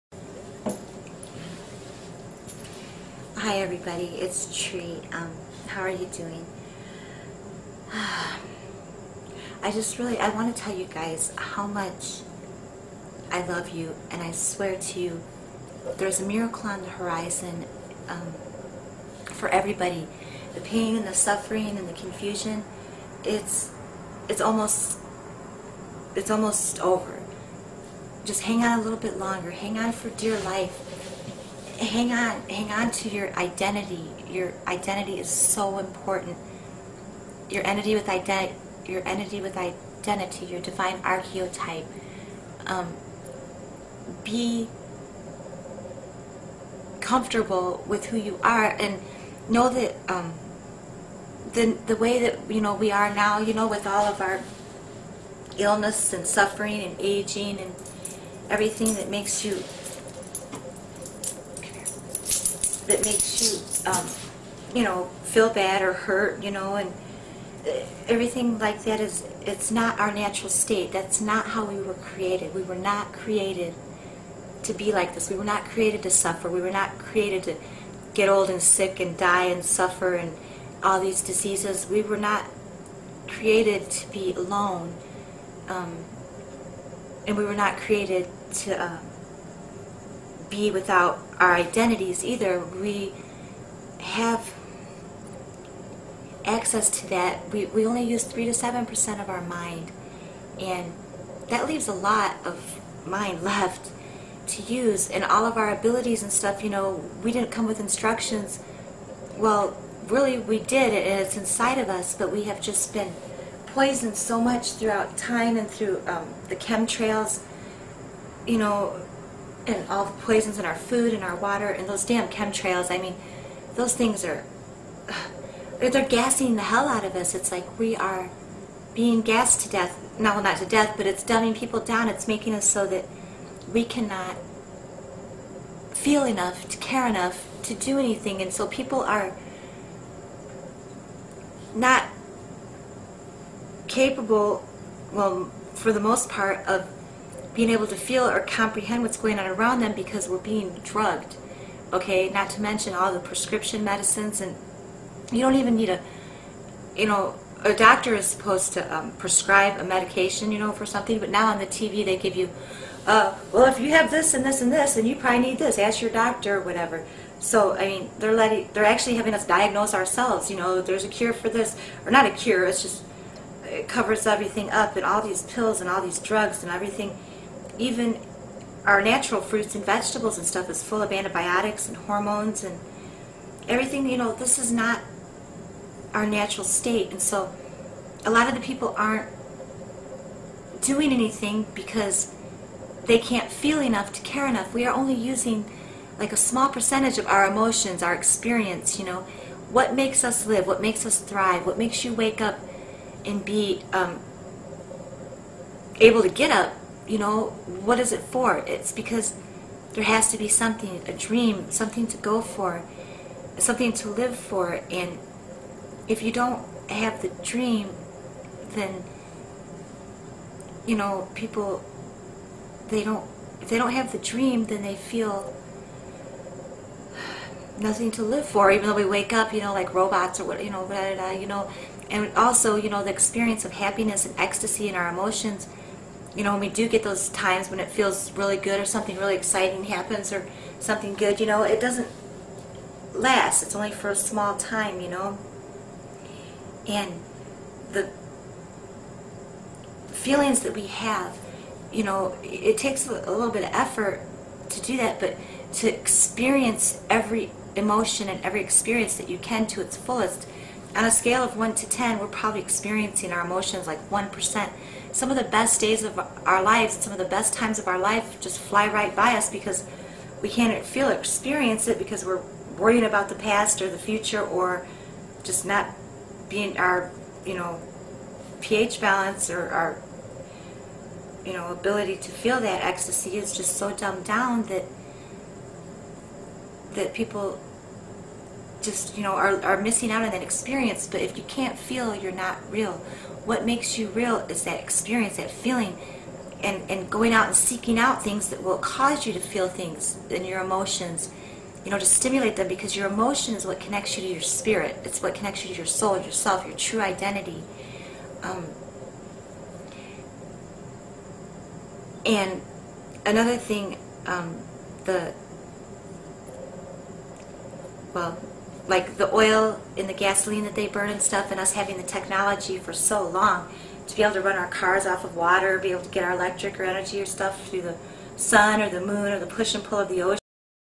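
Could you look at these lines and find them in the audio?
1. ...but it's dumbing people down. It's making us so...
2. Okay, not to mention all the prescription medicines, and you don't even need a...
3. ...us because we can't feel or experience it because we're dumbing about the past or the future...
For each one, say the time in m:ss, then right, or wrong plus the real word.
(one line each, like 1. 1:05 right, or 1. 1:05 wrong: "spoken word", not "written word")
1. 2:10 right
2. 2:31 right
3. 4:29 wrong: "worrying", not "dumbing".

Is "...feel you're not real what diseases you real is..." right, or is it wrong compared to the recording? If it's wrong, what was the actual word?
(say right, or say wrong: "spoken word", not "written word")
wrong: "makes", not "diseases".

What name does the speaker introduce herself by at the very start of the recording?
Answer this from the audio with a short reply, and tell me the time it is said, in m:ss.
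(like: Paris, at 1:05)
Tree, at 0:04.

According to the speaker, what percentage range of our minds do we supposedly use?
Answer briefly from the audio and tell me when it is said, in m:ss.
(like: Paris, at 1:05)
3 to 7%, at 1:38.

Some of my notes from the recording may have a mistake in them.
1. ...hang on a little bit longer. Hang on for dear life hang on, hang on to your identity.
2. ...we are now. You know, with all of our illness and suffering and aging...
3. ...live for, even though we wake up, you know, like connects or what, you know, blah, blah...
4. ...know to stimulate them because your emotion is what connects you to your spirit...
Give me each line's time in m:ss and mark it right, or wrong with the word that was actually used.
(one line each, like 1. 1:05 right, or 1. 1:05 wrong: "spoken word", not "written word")
1. 0:28 right
2. 0:52 right
3. 3:48 wrong: "robots", not "connects"
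4. 5:01 right.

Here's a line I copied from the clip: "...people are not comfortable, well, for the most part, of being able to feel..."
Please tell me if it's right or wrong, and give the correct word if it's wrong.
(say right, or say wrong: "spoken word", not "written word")
wrong: "capable", not "comfortable".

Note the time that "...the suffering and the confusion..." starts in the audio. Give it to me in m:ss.
0:21.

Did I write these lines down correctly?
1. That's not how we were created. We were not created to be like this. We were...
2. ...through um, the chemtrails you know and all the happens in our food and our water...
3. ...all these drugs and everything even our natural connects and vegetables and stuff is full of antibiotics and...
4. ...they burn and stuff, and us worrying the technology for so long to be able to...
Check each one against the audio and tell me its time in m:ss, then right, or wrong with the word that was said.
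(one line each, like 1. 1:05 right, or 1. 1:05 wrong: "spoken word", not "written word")
1. 1:10 right
2. 1:55 wrong: "poisons", not "happens"
3. 2:55 wrong: "fruits", not "connects"
4. 5:20 wrong: "having", not "worrying".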